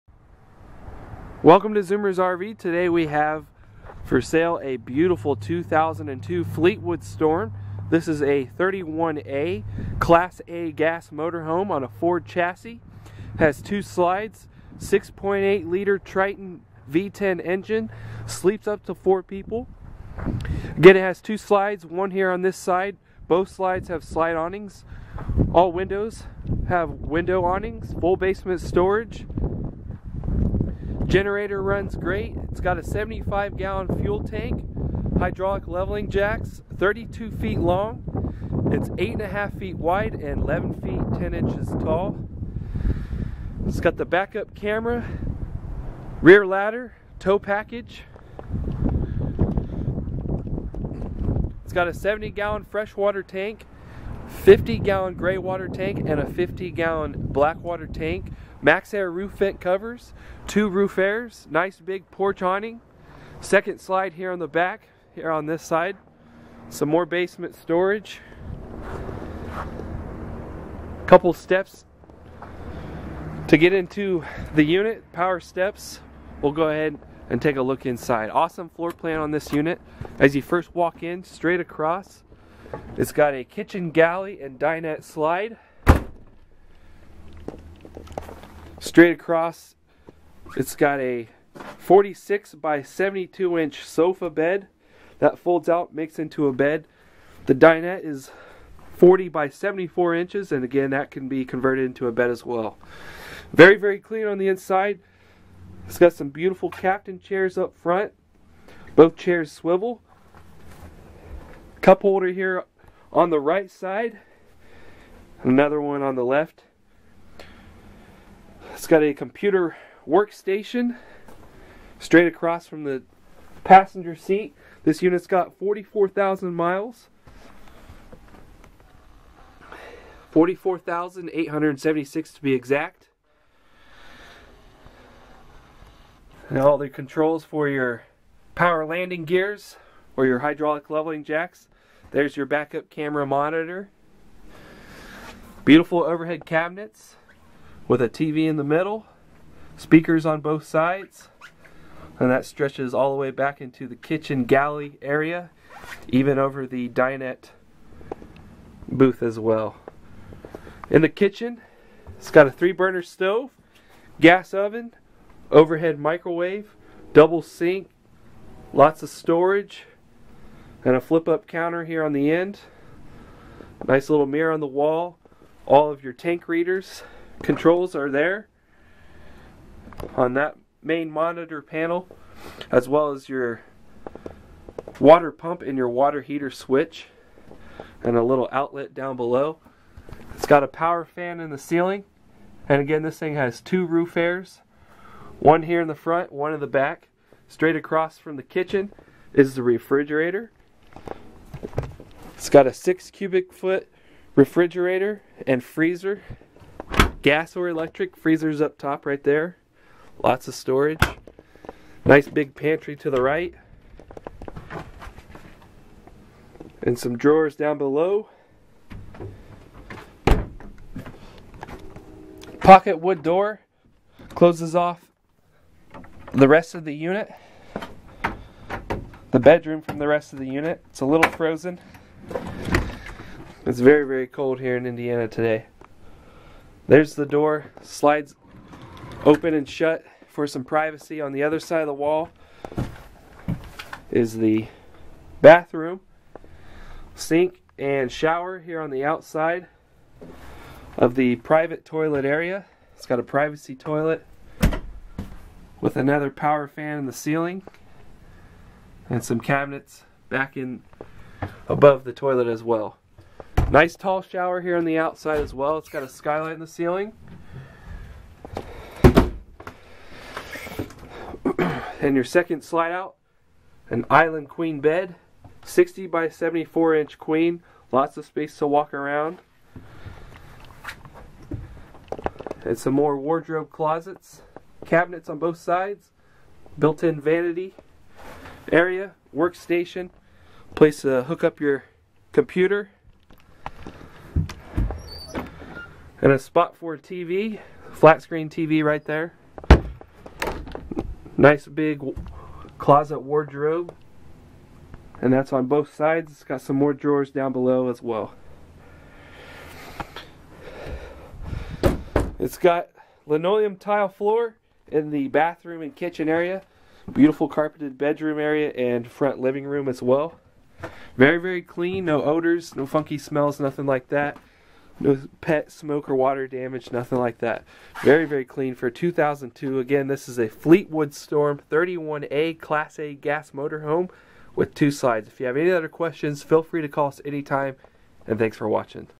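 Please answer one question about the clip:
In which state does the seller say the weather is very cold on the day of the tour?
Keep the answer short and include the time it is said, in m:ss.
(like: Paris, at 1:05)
Indiana, at 3:54.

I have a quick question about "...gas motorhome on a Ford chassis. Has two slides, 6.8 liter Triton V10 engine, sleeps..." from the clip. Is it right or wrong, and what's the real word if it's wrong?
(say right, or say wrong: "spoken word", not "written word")
right.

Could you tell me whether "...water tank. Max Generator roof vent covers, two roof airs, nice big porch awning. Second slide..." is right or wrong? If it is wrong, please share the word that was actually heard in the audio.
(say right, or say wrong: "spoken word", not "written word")
wrong: "Air", not "Generator".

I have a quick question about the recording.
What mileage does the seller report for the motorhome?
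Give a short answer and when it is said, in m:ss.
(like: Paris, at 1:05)
44,876, at 2:10.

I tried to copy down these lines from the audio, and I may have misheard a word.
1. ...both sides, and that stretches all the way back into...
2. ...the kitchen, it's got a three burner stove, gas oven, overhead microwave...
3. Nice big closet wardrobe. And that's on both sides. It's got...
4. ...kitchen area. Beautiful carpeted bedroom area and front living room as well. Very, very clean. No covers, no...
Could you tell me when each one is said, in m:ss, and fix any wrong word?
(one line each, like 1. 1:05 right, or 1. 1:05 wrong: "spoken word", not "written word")
1. 2:30 right
2. 2:41 right
3. 5:01 right
4. 5:15 wrong: "odors", not "covers".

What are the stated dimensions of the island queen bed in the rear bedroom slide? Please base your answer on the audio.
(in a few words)
60 by 74 inches.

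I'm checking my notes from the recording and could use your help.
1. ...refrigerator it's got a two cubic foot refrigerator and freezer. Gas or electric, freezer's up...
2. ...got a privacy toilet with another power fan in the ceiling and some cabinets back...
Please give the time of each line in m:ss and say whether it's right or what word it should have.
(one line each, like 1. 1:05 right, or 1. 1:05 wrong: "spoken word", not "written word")
1. 3:19 wrong: "six", not "two"
2. 4:13 right.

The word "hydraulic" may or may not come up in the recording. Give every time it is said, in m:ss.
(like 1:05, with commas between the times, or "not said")
0:35, 2:20.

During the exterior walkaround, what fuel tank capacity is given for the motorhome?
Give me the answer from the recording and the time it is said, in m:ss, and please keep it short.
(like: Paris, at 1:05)
75 gallons, at 0:32.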